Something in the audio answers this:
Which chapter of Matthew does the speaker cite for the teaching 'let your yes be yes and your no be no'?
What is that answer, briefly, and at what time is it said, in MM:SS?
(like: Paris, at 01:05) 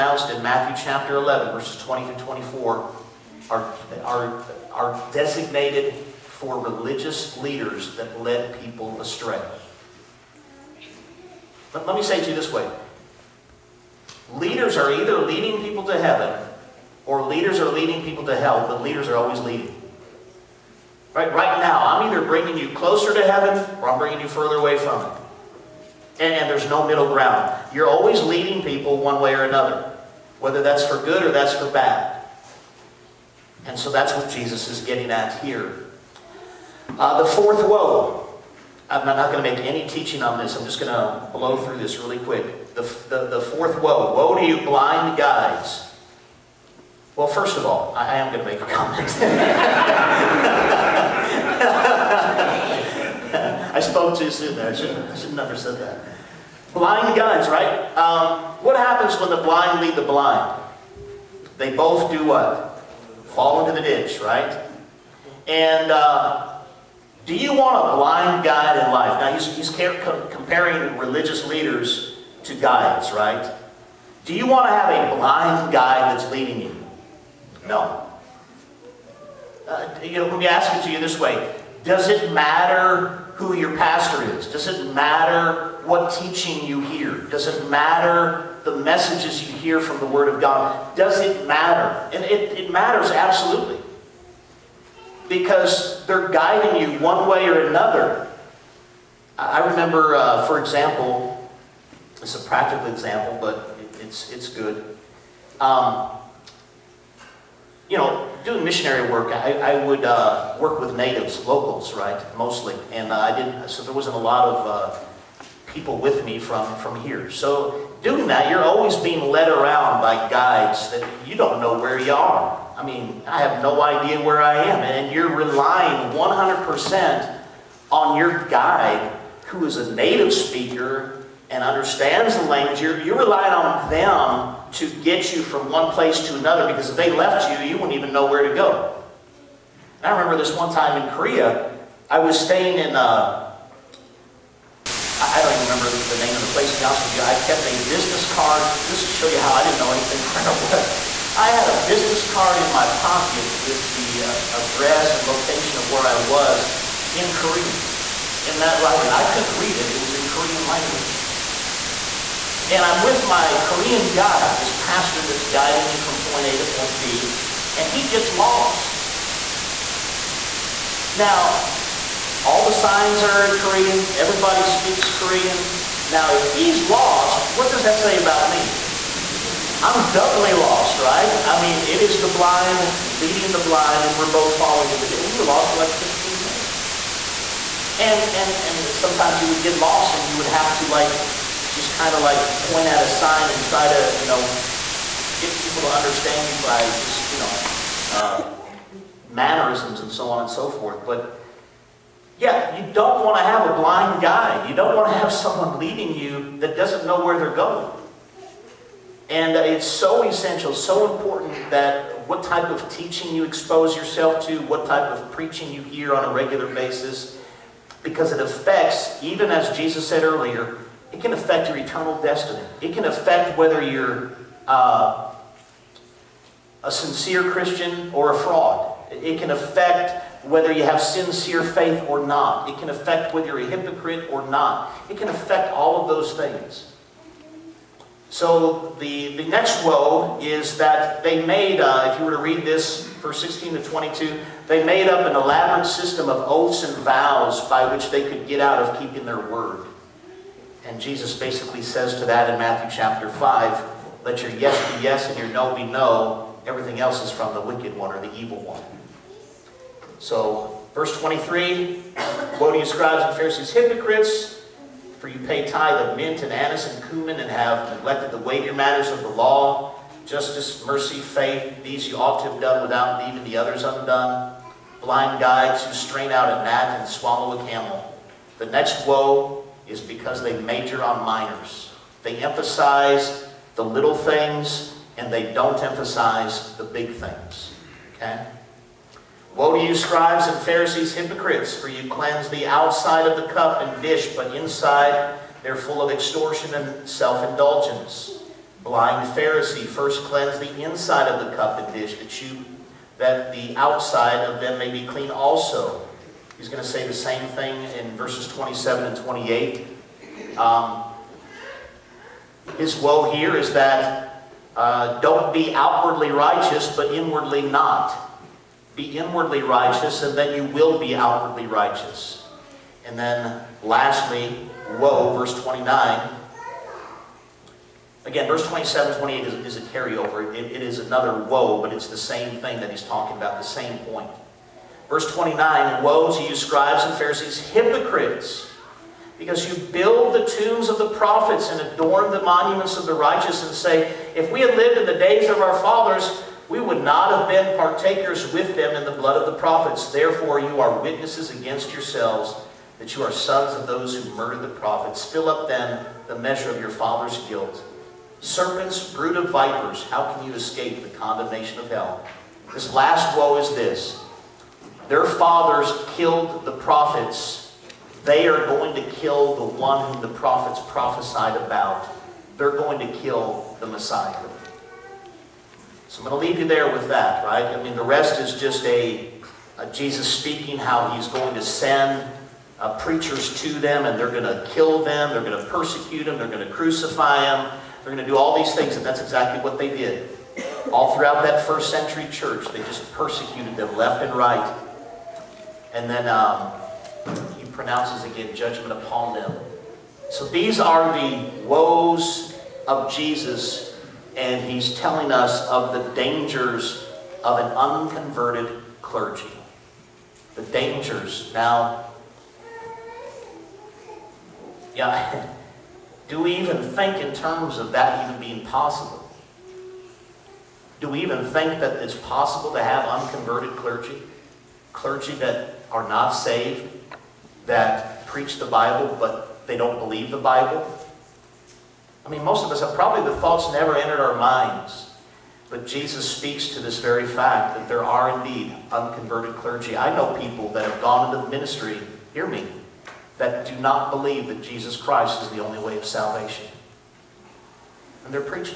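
Chapter 5, at 04:12.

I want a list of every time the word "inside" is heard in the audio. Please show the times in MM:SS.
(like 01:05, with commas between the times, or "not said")
04:54, 05:00.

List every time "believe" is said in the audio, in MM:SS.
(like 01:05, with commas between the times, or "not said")
07:09, 07:24.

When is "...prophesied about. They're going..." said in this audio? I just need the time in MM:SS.
06:10.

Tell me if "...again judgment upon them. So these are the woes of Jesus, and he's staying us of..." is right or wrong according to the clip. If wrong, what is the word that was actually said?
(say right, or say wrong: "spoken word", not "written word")
wrong: "telling", not "staying".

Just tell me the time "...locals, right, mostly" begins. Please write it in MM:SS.
01:51.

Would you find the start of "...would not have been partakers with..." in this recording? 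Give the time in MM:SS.
05:46.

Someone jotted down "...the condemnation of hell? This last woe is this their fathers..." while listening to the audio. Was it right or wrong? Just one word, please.
right.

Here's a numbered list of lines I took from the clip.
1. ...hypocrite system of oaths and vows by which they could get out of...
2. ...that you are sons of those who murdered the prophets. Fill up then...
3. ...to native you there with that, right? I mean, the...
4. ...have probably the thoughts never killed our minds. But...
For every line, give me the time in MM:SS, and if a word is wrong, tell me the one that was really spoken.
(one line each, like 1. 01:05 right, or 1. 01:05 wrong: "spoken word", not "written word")
1. 04:05 wrong: "elaborate", not "hypocrite"
2. 05:52 right
3. 06:16 wrong: "leave", not "native"
4. 07:12 wrong: "entered", not "killed".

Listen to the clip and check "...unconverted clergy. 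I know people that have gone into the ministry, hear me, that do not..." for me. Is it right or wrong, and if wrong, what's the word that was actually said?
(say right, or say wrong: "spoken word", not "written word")
right.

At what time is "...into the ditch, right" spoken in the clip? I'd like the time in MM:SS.
01:03.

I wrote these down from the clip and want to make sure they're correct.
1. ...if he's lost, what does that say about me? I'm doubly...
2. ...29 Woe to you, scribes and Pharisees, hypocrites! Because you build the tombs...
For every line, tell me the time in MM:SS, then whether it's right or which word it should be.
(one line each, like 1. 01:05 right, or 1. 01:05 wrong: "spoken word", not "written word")
1. 02:56 right
2. 05:35 right.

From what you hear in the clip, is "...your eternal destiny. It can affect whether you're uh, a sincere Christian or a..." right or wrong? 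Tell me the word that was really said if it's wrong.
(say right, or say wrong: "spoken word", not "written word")
right.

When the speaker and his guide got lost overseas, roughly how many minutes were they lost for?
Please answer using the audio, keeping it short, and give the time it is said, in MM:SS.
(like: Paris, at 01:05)
15, at 03:05.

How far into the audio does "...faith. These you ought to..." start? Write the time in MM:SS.
04:31.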